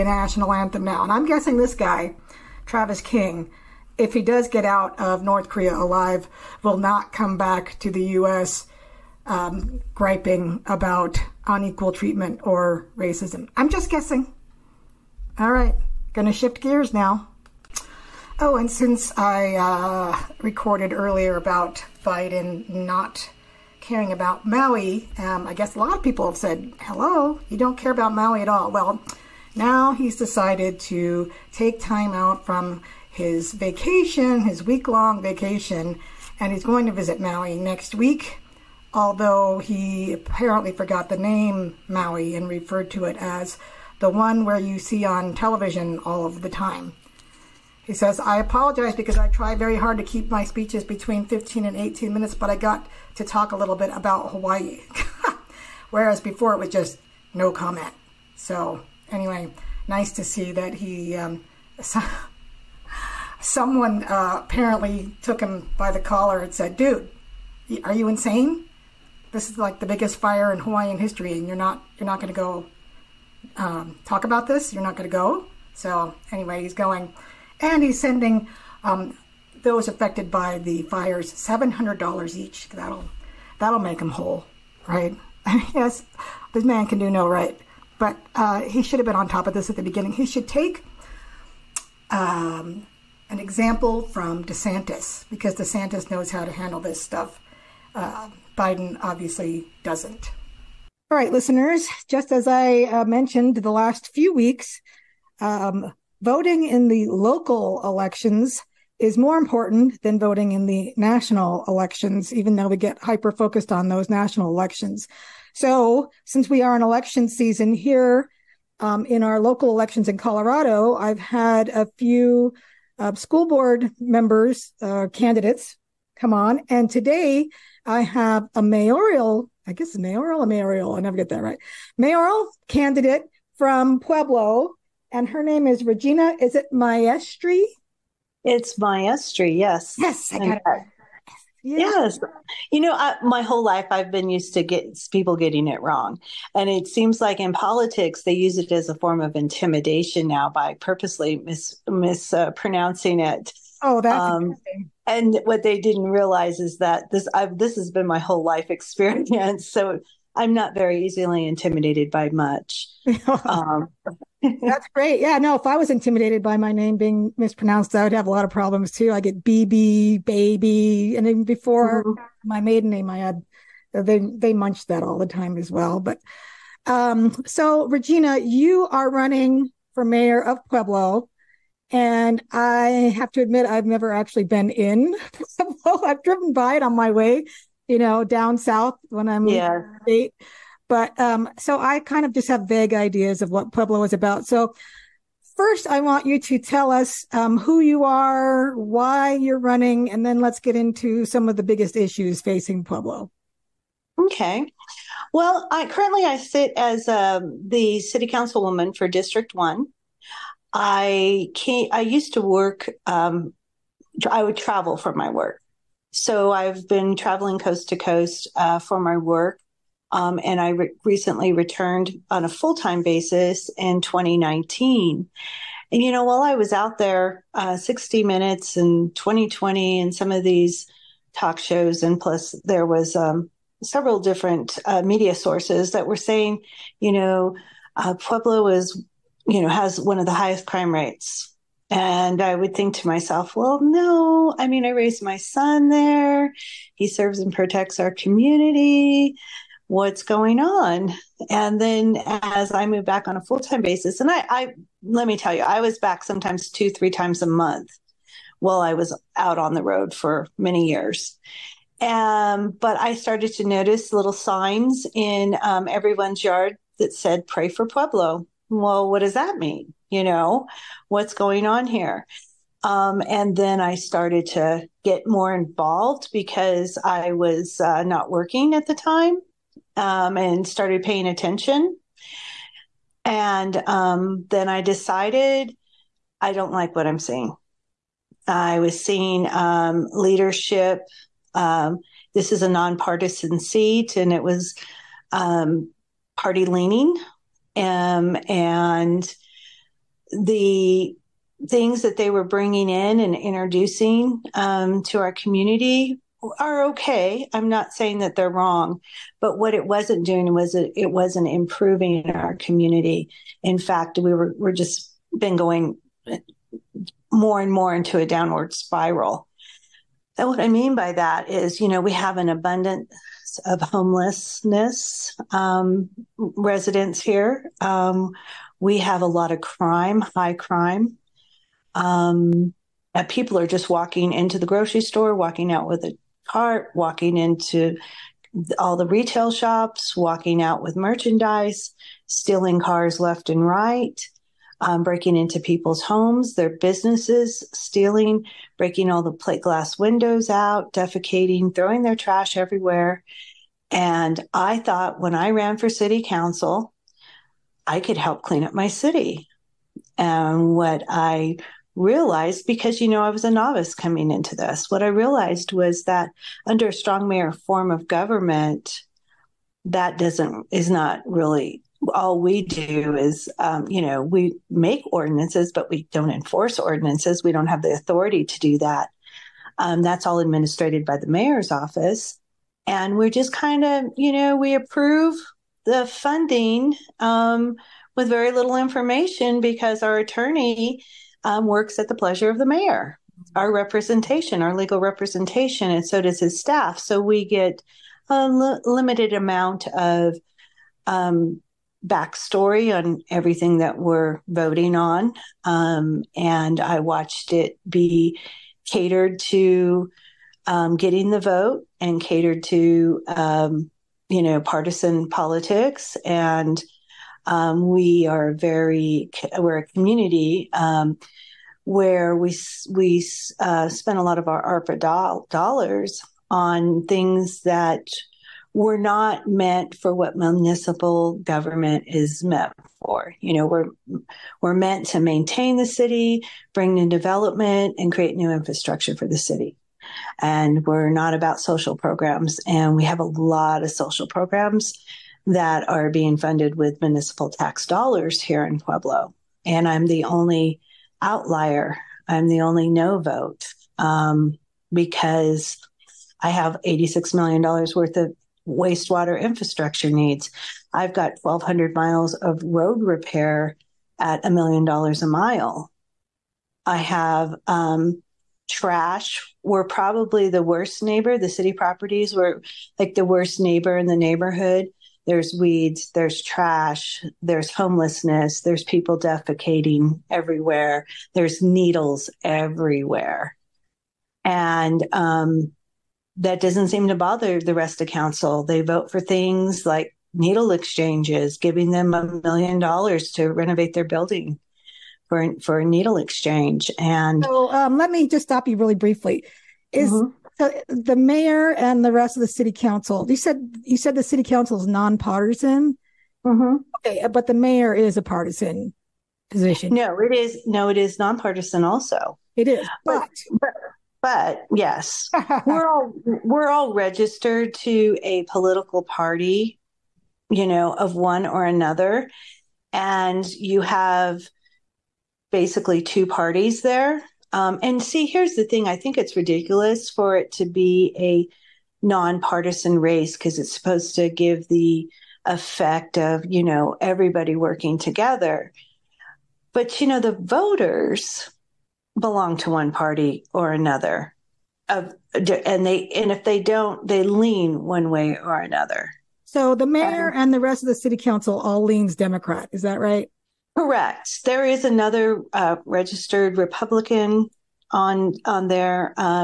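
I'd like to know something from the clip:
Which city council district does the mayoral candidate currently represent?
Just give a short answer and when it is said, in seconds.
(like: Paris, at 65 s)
District One, at 209 s.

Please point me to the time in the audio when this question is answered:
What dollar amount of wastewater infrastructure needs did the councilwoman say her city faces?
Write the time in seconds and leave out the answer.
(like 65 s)
456 s.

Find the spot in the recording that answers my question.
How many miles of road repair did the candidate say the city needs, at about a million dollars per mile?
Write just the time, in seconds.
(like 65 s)
461 s.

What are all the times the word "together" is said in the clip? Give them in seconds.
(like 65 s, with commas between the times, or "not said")
537 s.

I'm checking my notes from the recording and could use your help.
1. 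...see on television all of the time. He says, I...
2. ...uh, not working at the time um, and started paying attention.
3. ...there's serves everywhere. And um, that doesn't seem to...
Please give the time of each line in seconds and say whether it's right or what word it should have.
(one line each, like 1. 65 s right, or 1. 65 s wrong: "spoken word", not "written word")
1. 44 s right
2. 277 s right
3. 481 s wrong: "needles", not "serves".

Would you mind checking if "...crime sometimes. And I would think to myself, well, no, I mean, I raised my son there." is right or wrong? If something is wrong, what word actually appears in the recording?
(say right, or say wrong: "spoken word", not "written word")
wrong: "rates", not "sometimes".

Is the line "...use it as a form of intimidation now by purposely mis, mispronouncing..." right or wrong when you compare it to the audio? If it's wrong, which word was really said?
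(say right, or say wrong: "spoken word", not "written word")
right.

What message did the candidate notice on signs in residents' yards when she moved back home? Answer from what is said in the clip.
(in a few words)
Pray for Pueblo.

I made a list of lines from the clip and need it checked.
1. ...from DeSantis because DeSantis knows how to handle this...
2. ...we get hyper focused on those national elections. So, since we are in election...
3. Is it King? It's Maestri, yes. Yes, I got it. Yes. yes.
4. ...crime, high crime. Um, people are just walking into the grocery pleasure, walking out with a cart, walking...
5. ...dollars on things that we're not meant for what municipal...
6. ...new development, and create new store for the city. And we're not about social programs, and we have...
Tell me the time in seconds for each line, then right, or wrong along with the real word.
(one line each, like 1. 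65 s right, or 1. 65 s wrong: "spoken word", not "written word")
1. 94 s right
2. 112 s right
3. 136 s wrong: "Maestri", not "King"
4. 329 s wrong: "store", not "pleasure"
5. 425 s right
6. 436 s wrong: "infrastructure", not "store".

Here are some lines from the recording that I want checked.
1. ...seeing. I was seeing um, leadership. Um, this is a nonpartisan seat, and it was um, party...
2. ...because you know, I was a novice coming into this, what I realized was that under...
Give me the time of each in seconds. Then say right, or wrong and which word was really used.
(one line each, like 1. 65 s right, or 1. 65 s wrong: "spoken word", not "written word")
1. 287 s right
2. 362 s right.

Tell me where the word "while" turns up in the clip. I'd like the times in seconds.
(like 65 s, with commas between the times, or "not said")
226 s, 258 s.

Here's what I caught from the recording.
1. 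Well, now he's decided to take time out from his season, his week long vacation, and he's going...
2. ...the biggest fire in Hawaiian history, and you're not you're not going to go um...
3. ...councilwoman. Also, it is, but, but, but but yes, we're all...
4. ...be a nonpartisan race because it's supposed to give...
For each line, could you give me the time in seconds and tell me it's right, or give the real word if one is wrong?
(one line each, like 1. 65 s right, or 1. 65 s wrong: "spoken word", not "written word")
1. 28 s wrong: "vacation", not "season"
2. 69 s right
3. 511 s wrong: "nonpartisan", not "councilwoman"
4. 530 s right.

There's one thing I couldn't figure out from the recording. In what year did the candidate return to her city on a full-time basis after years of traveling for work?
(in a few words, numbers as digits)
2019.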